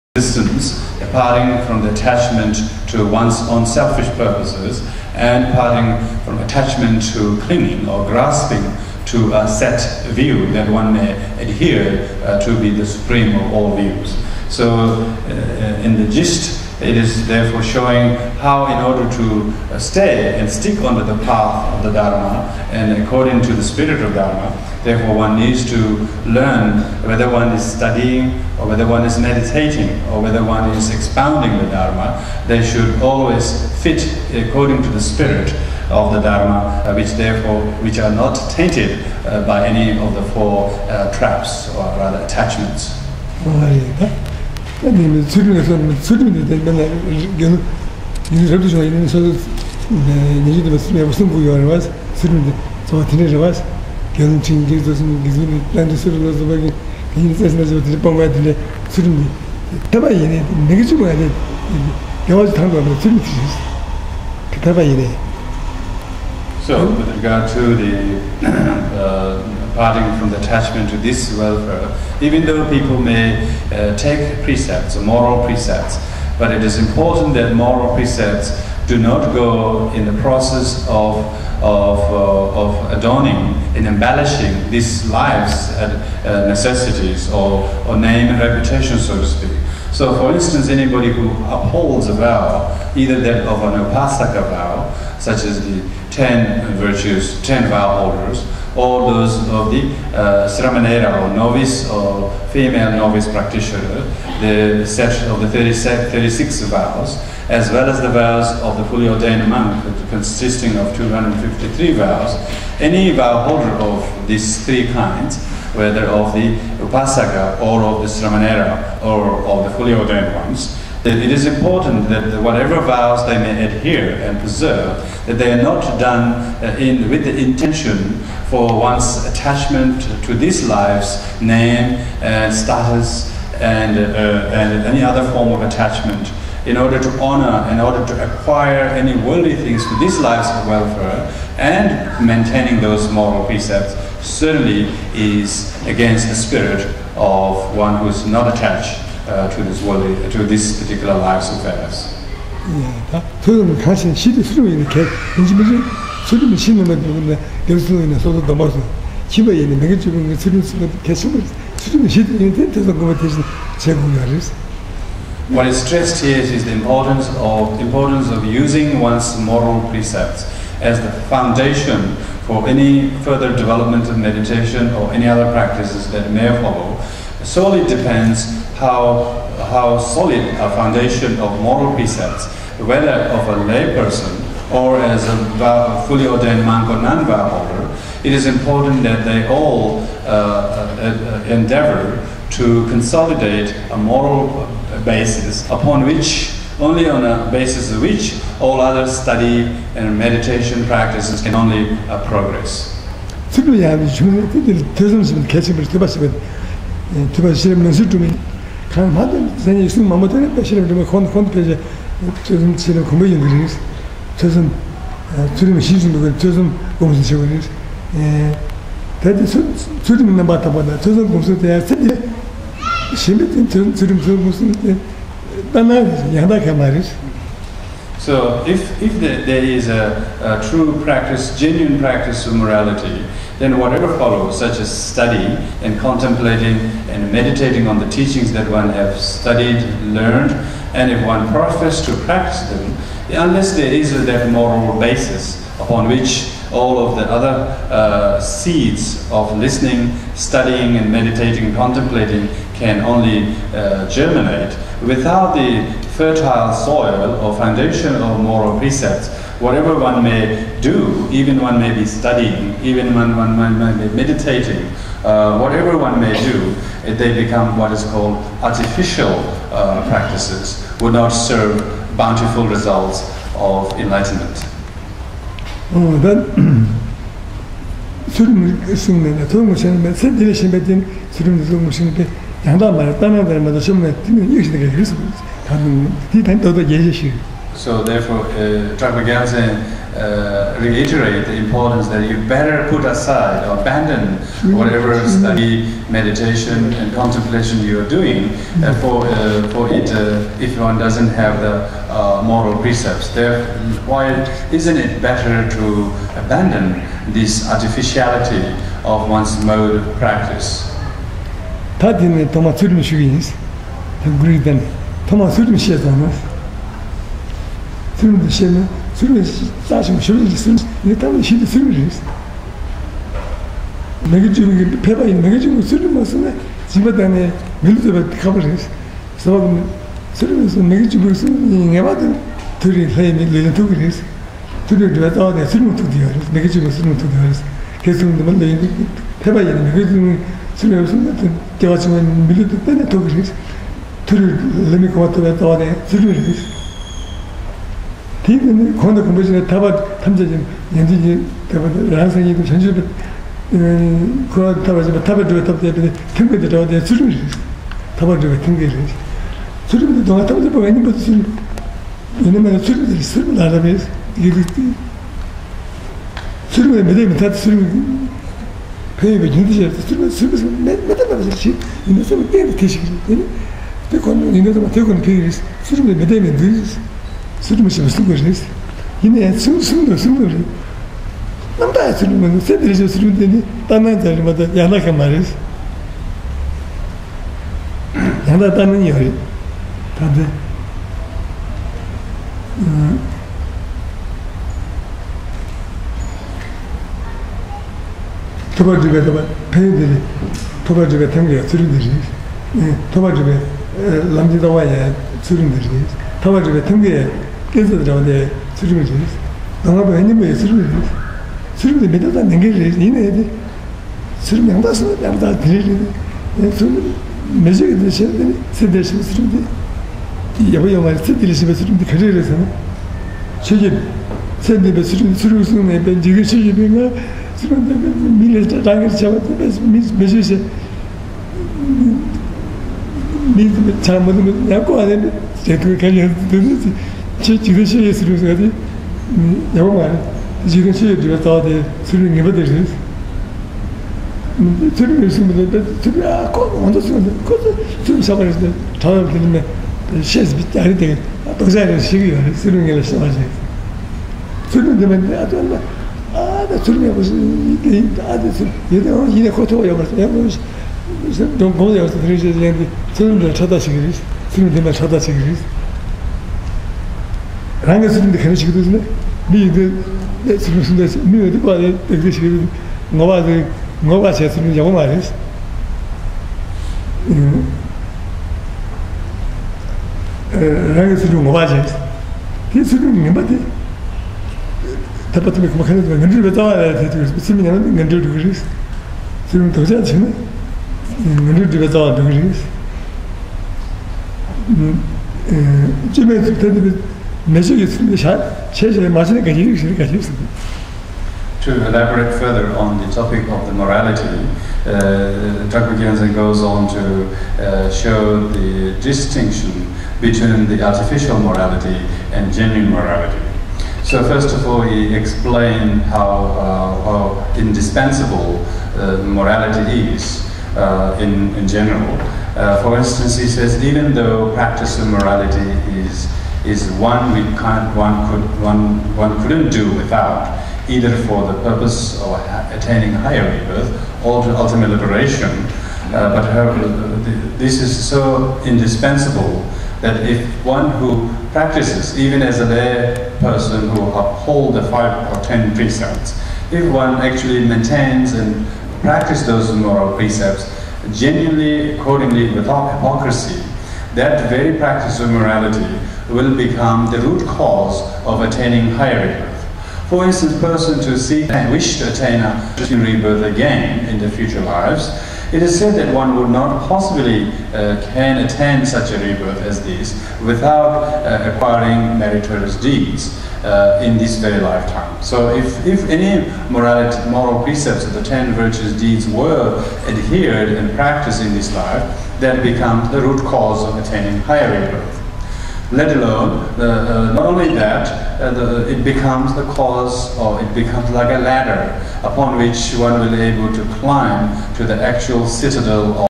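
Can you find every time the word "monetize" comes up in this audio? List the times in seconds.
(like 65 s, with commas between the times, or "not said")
not said.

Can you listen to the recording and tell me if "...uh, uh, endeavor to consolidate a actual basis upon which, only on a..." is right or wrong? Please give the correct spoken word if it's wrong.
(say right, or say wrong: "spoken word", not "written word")
wrong: "moral", not "actual".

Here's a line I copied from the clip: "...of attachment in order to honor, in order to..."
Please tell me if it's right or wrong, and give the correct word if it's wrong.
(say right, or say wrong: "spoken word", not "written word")
right.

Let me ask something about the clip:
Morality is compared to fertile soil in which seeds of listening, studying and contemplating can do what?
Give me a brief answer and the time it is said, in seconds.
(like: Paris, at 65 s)
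germinate, at 254 s.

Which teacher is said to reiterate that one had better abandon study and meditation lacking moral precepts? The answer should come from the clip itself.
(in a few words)
Drakpa Gyaltsen.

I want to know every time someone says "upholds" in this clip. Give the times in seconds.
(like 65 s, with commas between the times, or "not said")
91 s, 544 s.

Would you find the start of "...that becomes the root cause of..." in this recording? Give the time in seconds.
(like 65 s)
582 s.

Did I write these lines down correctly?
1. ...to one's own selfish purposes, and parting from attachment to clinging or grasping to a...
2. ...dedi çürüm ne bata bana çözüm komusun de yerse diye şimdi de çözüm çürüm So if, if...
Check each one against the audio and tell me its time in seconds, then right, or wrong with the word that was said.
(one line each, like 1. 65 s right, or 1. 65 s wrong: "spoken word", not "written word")
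1. 2 s right
2. 219 s right.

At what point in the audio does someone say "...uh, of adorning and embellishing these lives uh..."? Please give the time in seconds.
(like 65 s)
82 s.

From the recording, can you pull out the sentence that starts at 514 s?
So first of all, he explained how, uh, how indispensable uh, morality is uh, in, in, general.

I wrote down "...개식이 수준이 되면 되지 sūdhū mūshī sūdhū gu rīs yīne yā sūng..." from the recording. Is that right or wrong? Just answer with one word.
right.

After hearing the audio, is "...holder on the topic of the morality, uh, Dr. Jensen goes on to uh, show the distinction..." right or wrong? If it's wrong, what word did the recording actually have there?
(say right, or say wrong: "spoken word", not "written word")
wrong: "further", not "holder".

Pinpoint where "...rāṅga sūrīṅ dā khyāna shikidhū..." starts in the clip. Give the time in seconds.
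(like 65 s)
467 s.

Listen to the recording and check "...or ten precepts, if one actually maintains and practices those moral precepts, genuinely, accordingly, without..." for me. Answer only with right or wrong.
right.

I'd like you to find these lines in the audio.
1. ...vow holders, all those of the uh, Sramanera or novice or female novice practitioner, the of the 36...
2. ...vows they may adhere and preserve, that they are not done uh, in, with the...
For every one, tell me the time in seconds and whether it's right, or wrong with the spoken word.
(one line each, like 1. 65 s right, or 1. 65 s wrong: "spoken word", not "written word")
1. 97 s right
2. 122 s right.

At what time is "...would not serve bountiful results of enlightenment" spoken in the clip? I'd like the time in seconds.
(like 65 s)
271 s.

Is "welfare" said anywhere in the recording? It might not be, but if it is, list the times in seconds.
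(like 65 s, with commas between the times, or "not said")
71 s, 140 s.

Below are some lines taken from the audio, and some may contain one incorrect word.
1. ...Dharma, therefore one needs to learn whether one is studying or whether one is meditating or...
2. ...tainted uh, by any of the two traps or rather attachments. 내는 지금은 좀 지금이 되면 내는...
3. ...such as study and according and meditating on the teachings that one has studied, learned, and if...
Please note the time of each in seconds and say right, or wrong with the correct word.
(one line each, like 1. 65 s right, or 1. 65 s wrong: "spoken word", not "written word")
1. 24 s right
2. 38 s wrong: "four", not "two"
3. 234 s wrong: "contemplating", not "according".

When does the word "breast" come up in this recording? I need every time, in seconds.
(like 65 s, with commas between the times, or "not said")
not said.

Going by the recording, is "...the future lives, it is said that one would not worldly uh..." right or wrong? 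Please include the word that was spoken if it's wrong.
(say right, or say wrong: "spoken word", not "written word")
wrong: "possibly", not "worldly".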